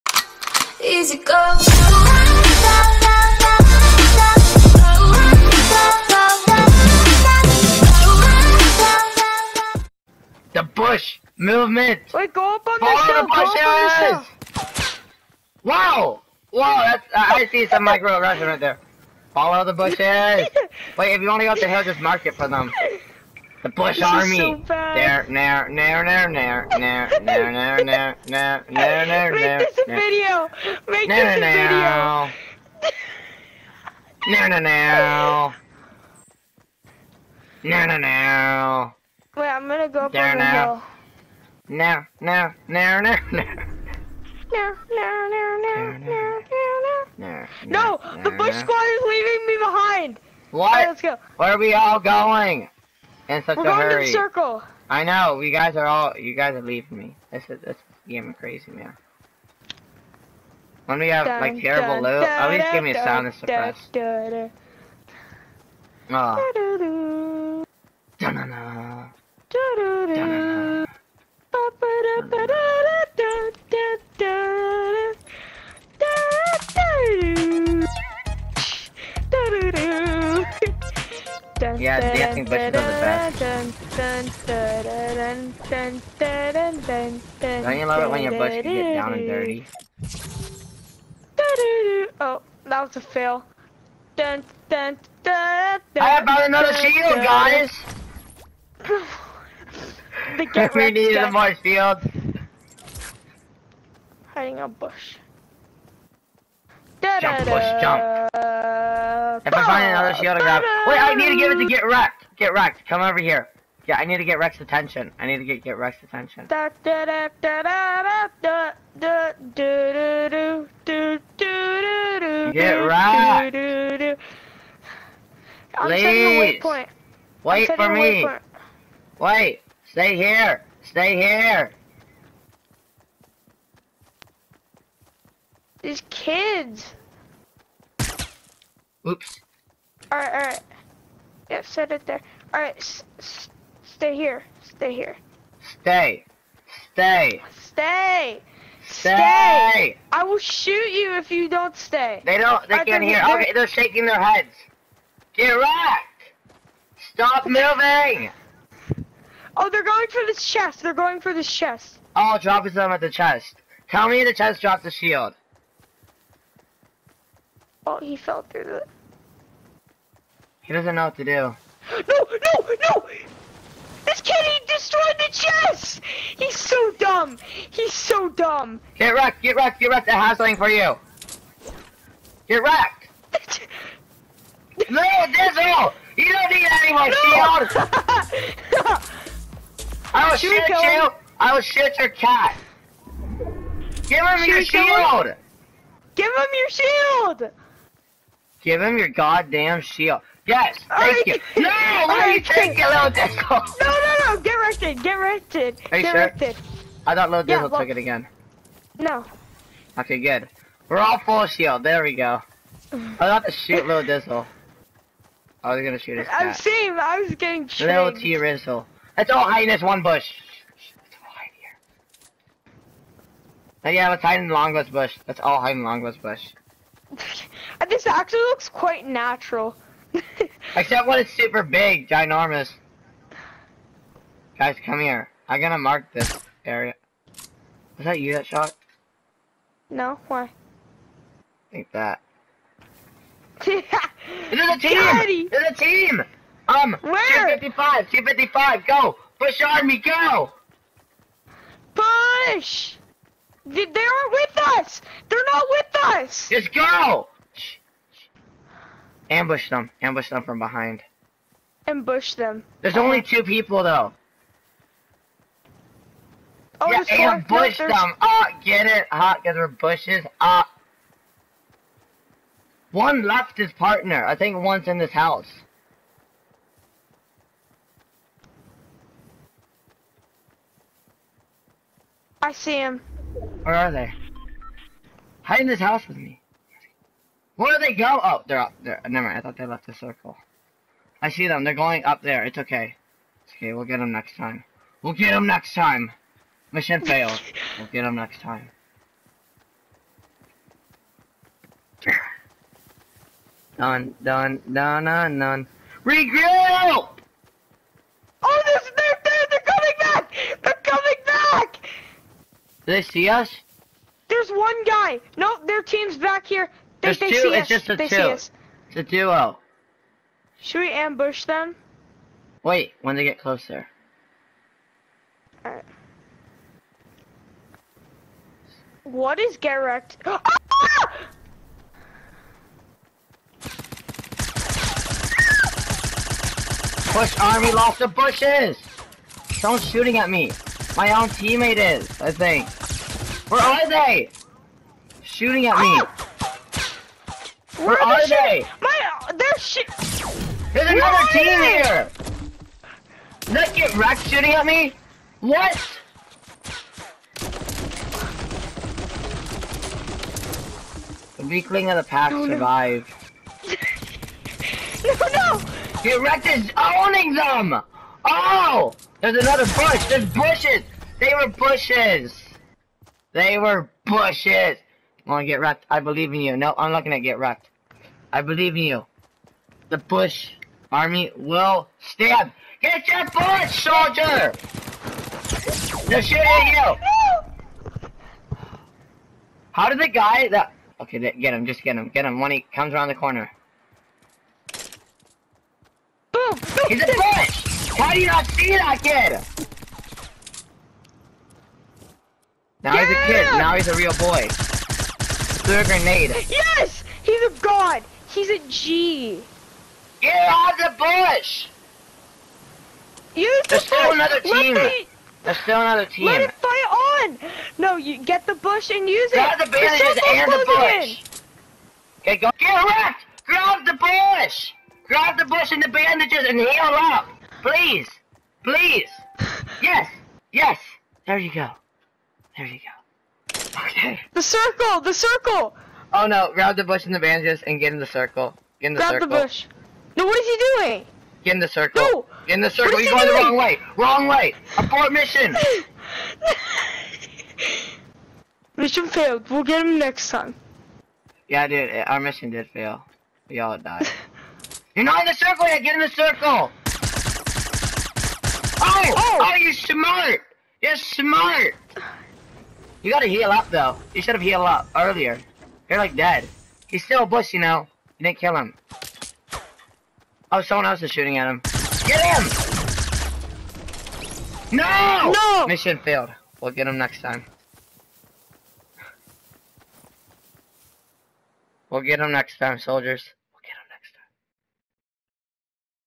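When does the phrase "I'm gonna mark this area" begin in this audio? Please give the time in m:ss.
3:55.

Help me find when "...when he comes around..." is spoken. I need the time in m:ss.
6:32.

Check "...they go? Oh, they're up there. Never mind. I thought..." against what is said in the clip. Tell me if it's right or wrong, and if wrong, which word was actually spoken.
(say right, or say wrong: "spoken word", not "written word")
right.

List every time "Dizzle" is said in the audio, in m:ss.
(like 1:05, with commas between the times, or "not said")
3:05, 3:27, 3:34.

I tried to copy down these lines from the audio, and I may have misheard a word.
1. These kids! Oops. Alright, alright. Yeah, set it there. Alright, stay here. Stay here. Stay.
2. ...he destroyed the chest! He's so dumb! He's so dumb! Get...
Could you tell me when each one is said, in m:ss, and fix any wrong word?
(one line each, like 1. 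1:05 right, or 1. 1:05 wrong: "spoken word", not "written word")
1. 2:15 right
2. 2:54 right.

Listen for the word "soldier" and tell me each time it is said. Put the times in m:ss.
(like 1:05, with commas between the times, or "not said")
6:23, 8:02.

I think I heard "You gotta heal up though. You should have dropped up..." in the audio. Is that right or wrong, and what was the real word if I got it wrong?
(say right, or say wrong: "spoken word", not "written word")
wrong: "healed", not "dropped".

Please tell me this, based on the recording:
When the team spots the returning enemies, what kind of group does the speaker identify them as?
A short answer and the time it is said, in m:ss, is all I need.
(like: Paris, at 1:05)
duo, at 5:19.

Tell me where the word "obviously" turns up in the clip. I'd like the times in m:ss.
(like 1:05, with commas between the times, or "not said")
not said.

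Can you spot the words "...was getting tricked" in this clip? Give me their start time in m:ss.
3:37.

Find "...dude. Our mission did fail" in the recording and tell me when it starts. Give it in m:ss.
7:31.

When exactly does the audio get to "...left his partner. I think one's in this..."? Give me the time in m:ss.
4:33.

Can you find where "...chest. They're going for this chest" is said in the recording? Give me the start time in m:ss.
2:40.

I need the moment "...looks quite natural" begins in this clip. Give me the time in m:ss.
3:48.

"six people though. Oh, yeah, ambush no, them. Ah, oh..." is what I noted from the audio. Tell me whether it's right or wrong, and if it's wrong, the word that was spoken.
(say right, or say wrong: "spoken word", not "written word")
wrong: "two", not "six".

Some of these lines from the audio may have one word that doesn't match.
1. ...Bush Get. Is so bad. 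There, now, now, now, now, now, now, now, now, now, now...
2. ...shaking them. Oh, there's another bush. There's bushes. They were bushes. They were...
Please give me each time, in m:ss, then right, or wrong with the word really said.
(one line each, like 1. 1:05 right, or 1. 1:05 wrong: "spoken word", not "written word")
1. 0:23 wrong: "Army", not "Get"
2. 6:06 wrong: "owning", not "shaking".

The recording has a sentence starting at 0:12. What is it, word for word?
Wait, go up on Follow the hill.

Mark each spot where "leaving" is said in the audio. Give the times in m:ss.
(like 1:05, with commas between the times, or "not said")
0:49, 0:56.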